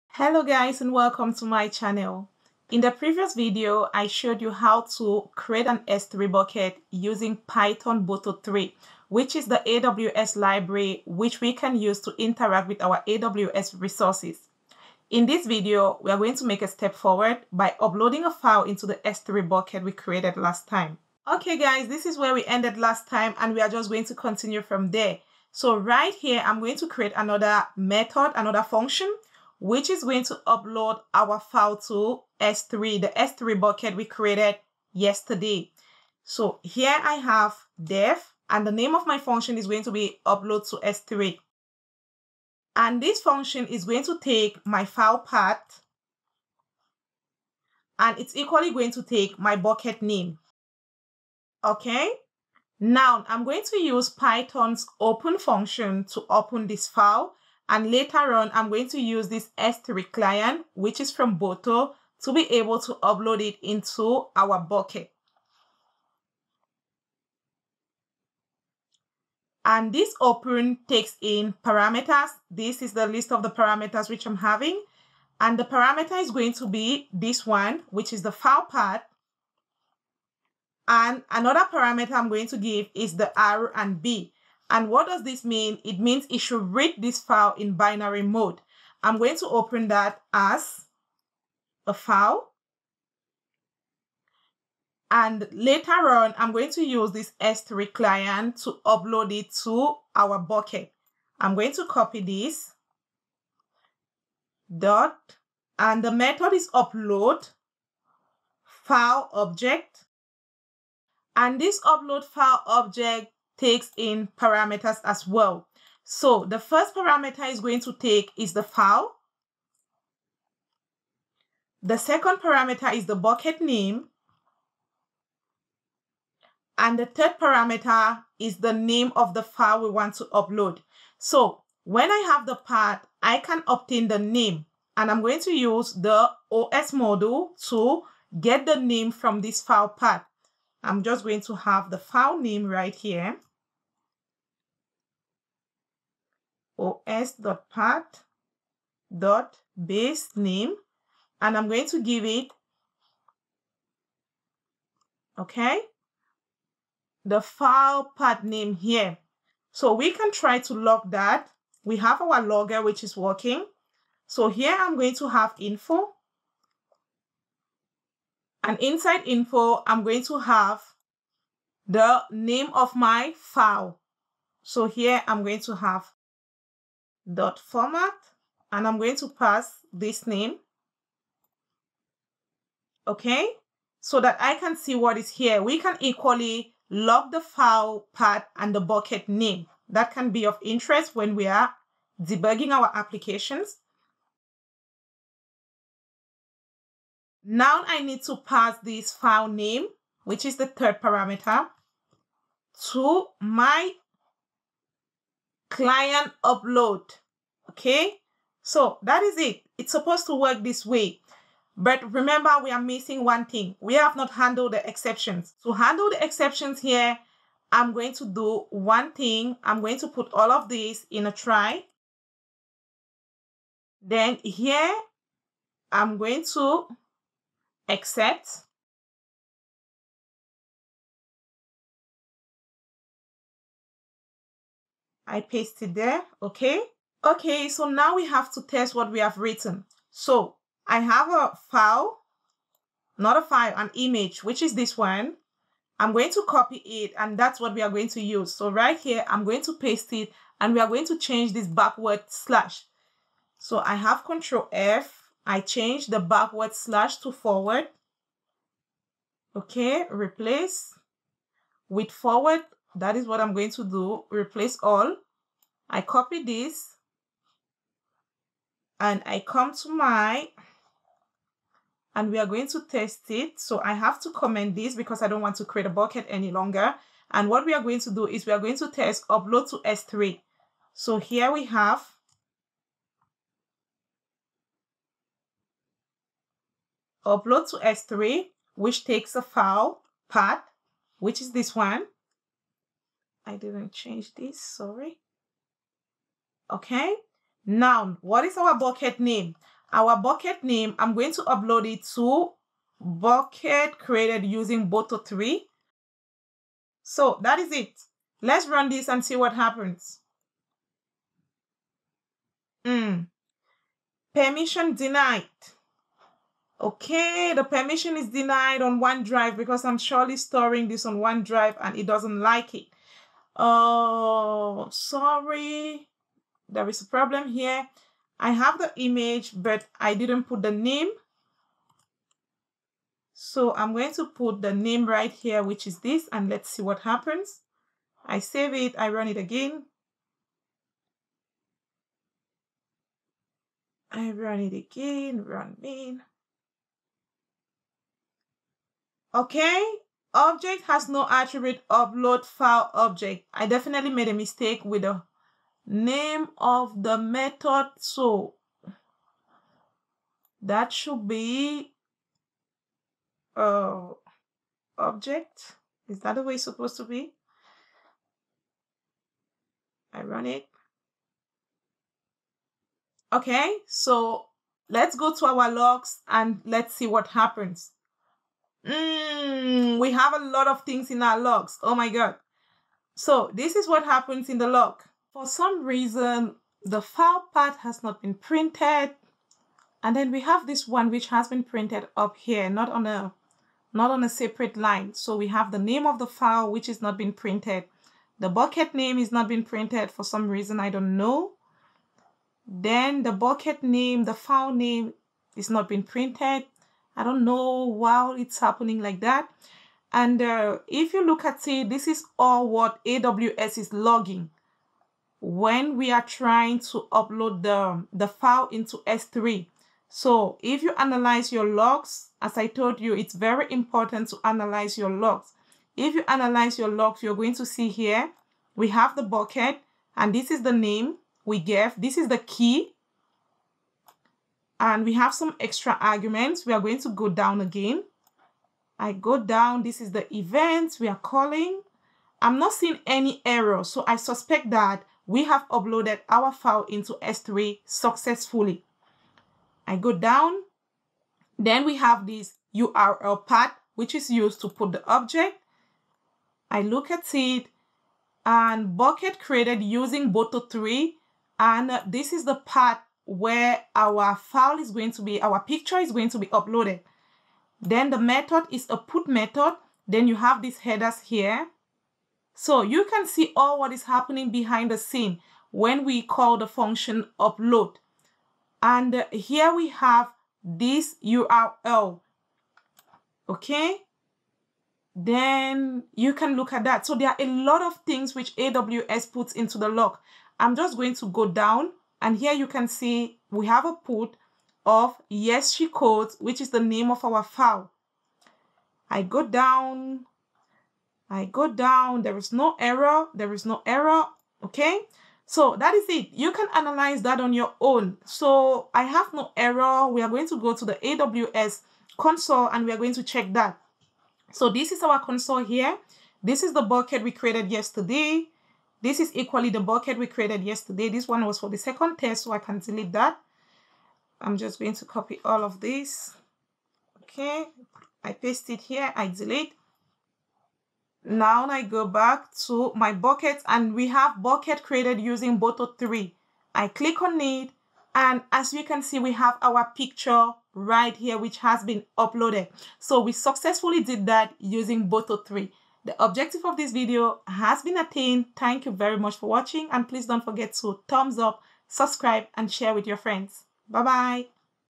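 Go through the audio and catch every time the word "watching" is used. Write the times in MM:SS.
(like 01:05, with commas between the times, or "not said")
09:09.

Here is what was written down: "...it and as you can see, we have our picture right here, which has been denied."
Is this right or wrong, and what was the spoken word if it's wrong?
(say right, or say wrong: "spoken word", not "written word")
wrong: "uploaded", not "denied".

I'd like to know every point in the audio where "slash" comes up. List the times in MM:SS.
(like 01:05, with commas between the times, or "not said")
04:12, 04:16.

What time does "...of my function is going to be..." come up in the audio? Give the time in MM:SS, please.
00:38.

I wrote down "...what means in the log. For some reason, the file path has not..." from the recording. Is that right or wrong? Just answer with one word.
wrong.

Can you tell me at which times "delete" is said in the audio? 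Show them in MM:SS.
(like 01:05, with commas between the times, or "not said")
08:42, 08:49.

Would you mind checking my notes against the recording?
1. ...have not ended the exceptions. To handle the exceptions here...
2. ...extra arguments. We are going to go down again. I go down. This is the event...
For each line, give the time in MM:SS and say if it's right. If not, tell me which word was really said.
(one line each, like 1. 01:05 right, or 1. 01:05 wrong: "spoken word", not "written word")
1. 03:33 wrong: "handled", not "ended"
2. 07:15 right.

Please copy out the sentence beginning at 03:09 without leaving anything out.
That can be of interest when we are debugging our applications.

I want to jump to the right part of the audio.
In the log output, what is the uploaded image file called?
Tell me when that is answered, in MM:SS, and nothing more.
08:15.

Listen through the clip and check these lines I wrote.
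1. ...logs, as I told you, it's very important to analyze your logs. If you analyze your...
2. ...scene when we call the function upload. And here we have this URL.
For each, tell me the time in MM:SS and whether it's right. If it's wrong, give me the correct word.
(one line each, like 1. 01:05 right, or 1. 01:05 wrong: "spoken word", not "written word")
1. 07:01 right
2. 07:54 right.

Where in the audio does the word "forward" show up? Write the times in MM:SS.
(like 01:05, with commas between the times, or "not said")
00:16, 04:17, 04:22.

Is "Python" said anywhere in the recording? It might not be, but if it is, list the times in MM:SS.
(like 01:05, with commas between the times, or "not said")
00:07, 00:54.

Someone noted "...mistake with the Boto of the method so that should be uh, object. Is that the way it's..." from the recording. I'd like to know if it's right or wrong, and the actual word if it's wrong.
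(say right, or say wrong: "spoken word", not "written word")
wrong: "Name", not "Boto".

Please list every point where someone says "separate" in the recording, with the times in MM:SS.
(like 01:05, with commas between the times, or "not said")
06:34.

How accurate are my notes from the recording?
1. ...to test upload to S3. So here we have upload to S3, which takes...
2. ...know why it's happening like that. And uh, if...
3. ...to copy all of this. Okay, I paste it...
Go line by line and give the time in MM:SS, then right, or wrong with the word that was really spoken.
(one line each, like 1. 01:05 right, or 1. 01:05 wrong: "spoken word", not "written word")
1. 04:38 right
2. 06:47 right
3. 08:44 right.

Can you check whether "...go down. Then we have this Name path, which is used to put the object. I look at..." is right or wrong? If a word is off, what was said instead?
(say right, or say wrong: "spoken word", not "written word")
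wrong: "URL", not "Name".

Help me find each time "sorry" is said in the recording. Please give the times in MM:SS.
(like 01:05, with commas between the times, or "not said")
04:54, 05:24.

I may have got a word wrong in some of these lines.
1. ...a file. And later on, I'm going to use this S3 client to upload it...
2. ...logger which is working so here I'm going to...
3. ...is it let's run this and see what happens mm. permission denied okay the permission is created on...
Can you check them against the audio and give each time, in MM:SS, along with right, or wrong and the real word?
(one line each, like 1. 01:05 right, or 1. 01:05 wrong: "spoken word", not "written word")
1. 01:31 right
2. 02:42 right
3. 05:07 wrong: "denied", not "created".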